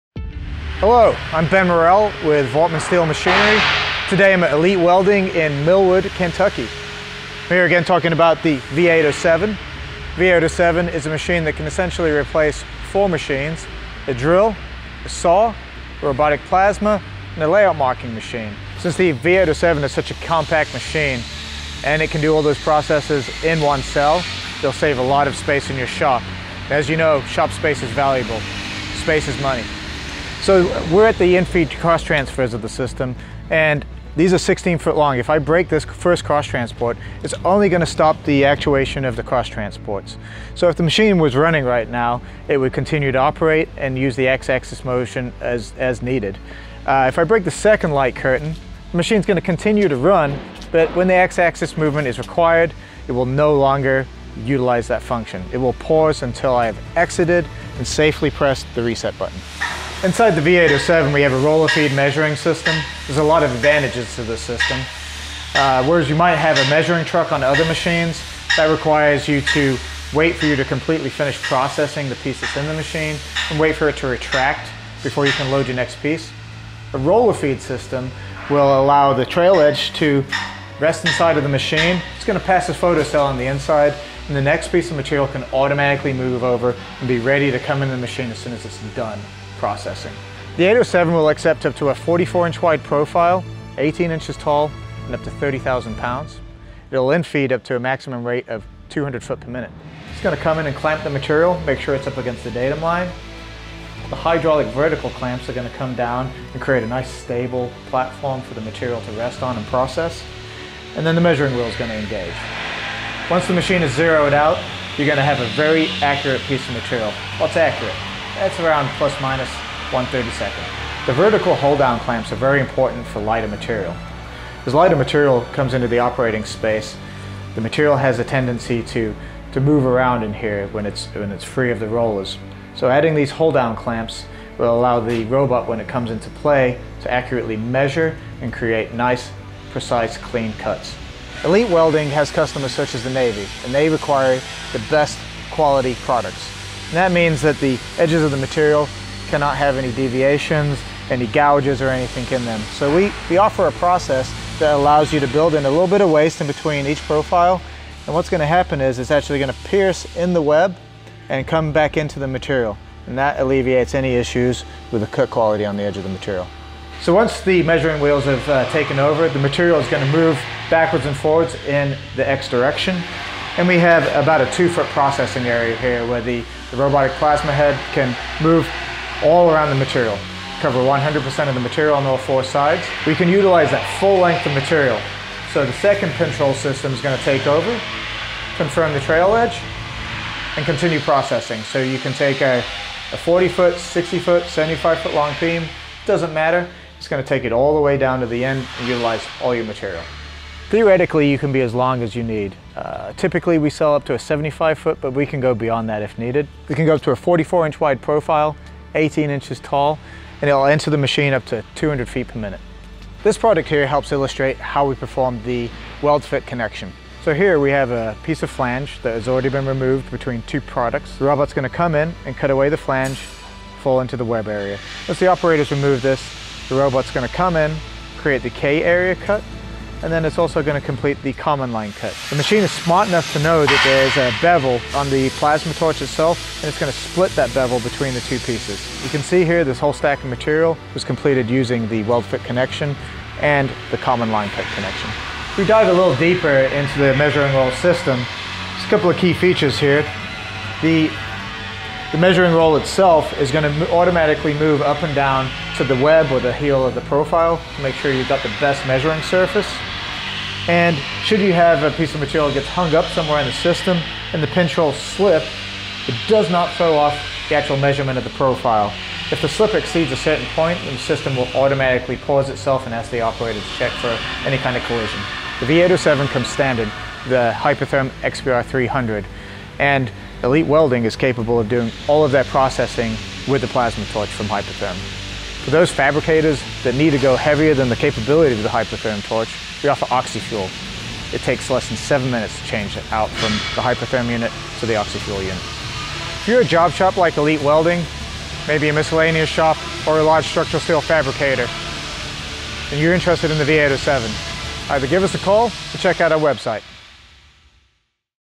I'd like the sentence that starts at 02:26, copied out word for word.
And that means that the edges of the material cannot have any deviations, any gouges or anything in them.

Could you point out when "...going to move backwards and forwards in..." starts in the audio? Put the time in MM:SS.
02:49.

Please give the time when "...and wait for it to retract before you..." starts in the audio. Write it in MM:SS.
01:13.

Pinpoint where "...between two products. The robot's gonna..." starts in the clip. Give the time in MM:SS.
03:40.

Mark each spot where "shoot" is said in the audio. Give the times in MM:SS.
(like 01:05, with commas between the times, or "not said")
not said.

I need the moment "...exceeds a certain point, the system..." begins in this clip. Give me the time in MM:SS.
04:29.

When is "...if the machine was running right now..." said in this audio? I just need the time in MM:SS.
00:40.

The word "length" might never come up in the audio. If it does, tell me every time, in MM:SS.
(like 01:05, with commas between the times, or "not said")
03:04.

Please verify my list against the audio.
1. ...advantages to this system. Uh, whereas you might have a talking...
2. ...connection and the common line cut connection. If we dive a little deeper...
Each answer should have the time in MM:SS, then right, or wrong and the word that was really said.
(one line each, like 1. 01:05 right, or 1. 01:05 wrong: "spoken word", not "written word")
1. 01:03 wrong: "measuring", not "talking"
2. 04:02 right.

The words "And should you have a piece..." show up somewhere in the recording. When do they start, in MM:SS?
04:20.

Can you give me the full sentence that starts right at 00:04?
Today I'm at Elite Welding in Millwood, Kentucky.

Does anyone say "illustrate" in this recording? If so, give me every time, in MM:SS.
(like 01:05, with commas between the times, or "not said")
03:34.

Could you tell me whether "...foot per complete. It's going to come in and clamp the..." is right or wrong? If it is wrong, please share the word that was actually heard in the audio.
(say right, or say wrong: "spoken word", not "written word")
wrong: "minute", not "complete".